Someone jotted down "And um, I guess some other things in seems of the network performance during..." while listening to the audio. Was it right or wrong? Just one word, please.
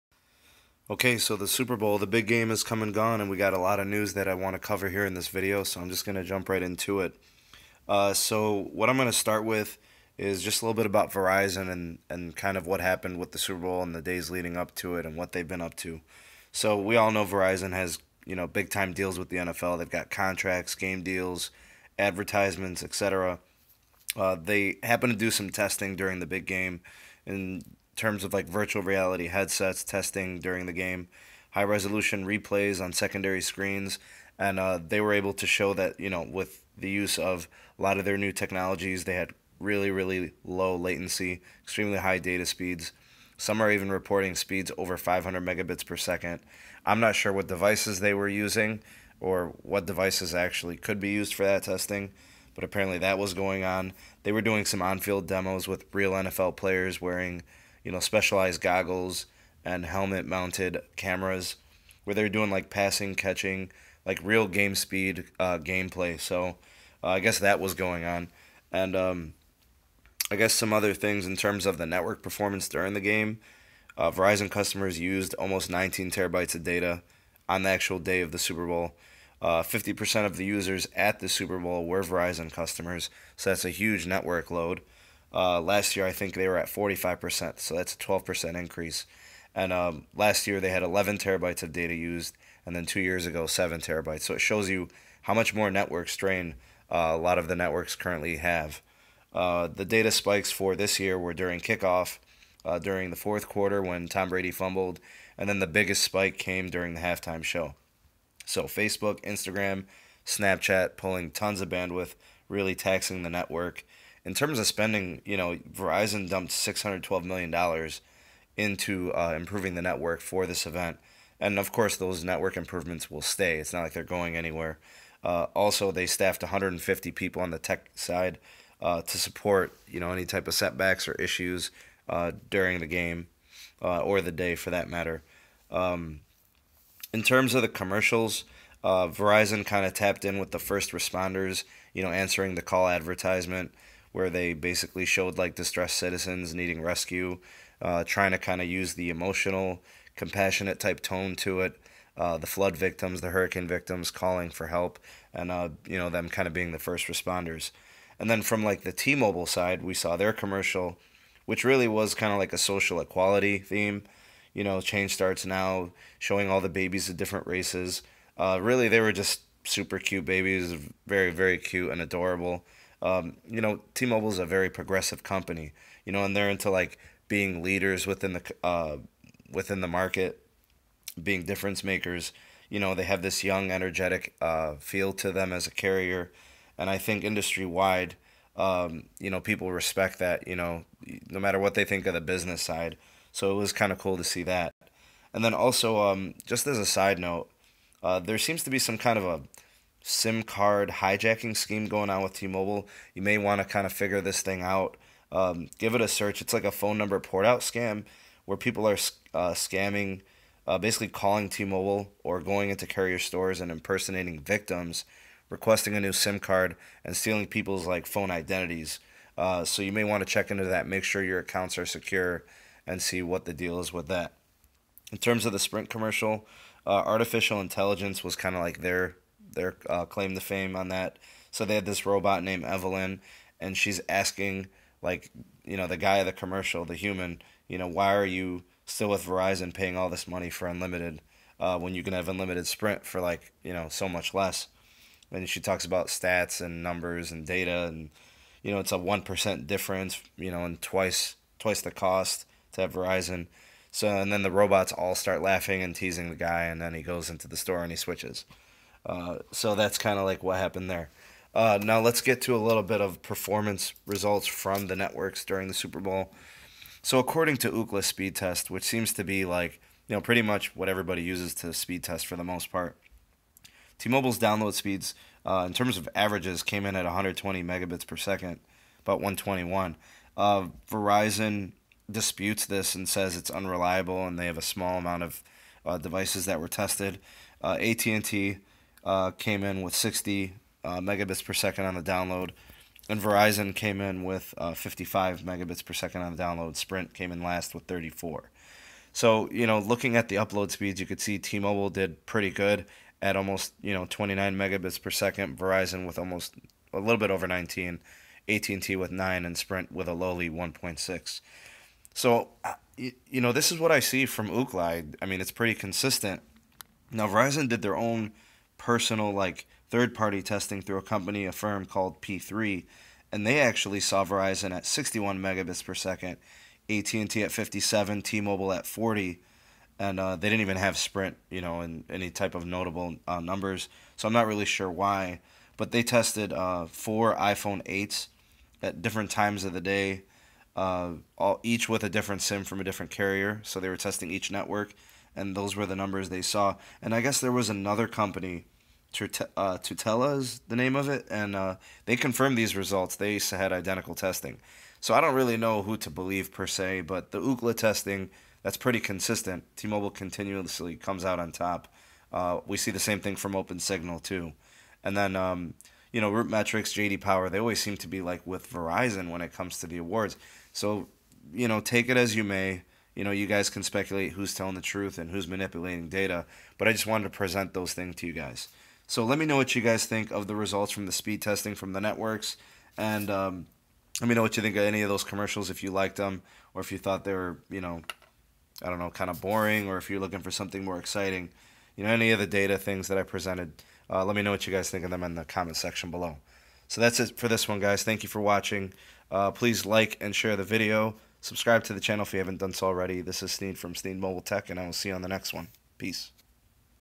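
wrong.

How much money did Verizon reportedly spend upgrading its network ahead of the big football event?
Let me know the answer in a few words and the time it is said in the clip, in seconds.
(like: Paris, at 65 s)
$612 million, at 116 s.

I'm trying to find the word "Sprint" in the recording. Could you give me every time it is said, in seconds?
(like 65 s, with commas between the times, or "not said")
225 s, 242 s, 296 s, 309 s, 330 s.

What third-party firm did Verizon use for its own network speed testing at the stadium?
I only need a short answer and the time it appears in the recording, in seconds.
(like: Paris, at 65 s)
P3, at 322 s.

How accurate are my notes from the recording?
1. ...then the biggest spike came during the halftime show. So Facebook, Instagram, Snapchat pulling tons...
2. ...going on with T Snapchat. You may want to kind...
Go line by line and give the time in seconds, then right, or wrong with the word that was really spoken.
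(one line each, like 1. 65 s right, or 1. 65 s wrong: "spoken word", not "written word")
1. 105 s right
2. 201 s wrong: "Mobile", not "Snapchat".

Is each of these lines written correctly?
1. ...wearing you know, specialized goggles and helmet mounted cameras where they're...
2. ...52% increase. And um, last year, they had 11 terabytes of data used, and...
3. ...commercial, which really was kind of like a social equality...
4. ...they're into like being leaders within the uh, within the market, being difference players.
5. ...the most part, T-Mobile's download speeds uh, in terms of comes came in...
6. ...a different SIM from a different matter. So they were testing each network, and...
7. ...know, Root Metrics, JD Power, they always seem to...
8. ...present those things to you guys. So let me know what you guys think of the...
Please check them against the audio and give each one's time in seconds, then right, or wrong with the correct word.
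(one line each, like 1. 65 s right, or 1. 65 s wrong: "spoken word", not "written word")
1. 57 s right
2. 87 s wrong: "12", not "52"
3. 160 s right
4. 176 s wrong: "makers", not "players"
5. 272 s wrong: "averages", not "comes"
6. 342 s wrong: "carrier", not "matter"
7. 366 s right
8. 377 s right.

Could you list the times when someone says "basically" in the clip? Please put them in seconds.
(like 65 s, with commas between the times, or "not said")
144 s, 210 s.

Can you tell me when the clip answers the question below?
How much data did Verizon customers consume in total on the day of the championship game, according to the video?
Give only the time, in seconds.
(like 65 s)
75 s.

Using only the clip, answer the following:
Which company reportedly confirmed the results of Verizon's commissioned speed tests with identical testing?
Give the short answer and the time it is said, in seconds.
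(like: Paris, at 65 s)
Tutela, at 349 s.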